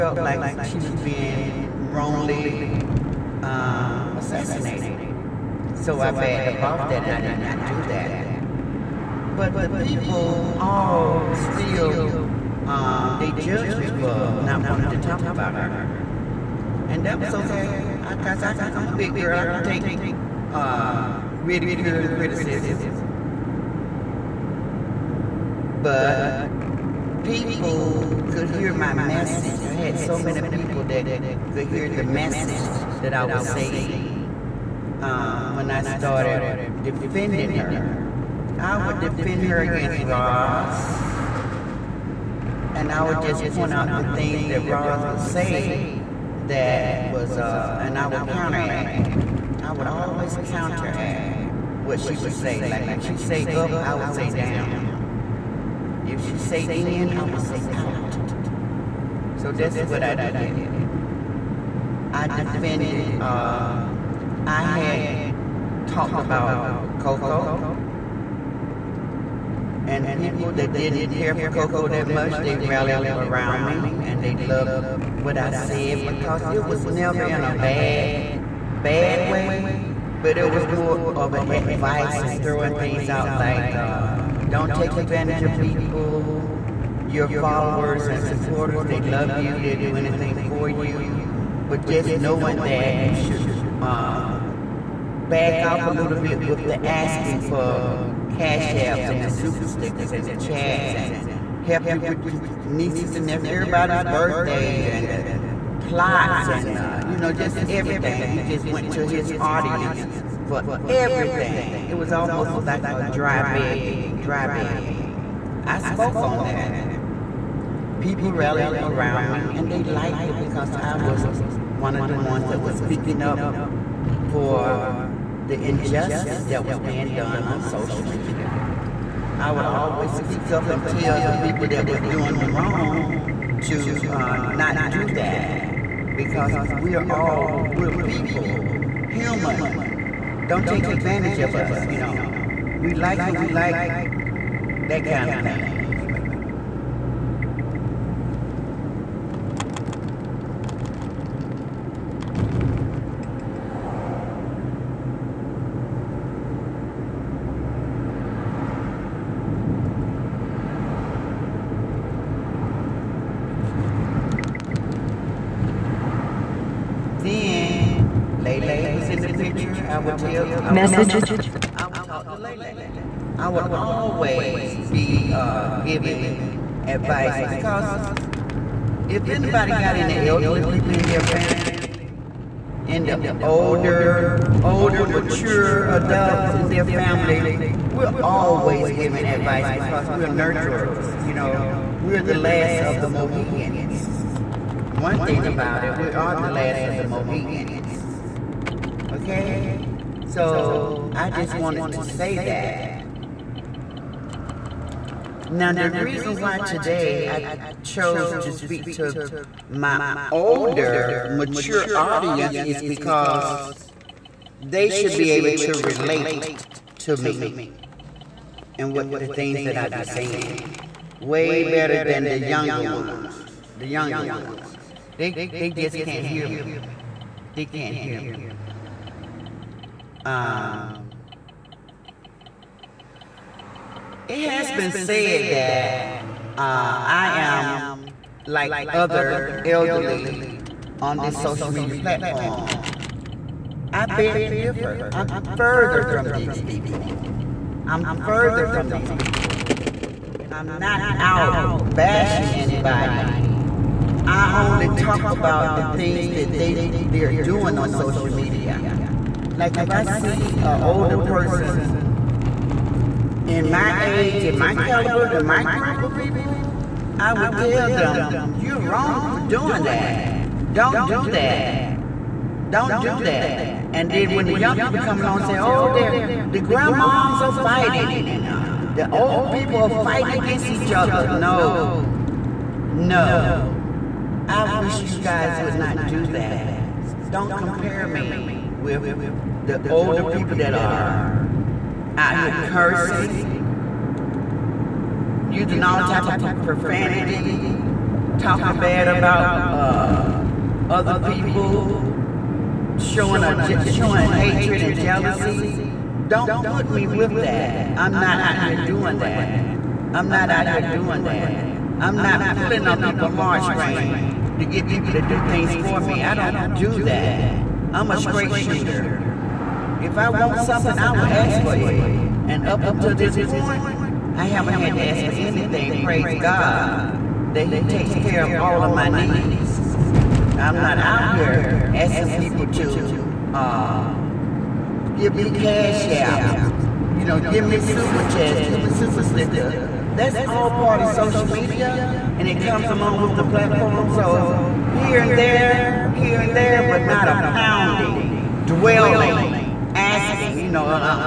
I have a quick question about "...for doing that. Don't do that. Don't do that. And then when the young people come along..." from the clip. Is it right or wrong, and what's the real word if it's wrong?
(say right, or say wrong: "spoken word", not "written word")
right.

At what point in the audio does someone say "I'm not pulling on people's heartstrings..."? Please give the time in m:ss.
5:11.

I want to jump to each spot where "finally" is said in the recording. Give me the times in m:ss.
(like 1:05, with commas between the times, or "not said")
not said.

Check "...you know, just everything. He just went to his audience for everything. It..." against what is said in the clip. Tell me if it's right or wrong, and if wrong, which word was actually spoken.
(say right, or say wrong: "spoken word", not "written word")
right.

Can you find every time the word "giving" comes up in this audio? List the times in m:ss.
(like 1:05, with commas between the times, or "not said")
2:55, 3:08.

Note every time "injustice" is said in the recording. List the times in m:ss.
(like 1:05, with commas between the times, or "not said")
2:05.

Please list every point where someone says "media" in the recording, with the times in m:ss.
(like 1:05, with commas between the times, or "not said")
2:08, 4:01, 4:18, 5:41.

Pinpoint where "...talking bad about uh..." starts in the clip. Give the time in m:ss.
4:58.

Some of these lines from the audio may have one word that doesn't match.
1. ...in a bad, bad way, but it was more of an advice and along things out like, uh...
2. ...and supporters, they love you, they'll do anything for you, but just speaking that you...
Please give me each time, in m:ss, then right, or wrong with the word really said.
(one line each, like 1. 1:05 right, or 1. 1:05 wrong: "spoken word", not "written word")
1. 1:17 wrong: "throwing", not "along"
2. 1:28 wrong: "knowing", not "speaking".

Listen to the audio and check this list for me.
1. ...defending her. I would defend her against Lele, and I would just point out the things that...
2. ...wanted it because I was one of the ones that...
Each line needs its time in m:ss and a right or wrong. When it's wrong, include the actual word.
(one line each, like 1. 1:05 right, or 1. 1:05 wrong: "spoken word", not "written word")
1. 0:36 wrong: "Roz", not "Lele"
2. 1:59 wrong: "liked", not "wanted".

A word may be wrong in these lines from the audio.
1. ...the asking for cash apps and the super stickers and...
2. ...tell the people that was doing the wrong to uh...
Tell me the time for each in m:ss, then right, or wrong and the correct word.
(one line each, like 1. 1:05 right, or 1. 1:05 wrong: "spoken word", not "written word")
1. 1:36 right
2. 2:10 right.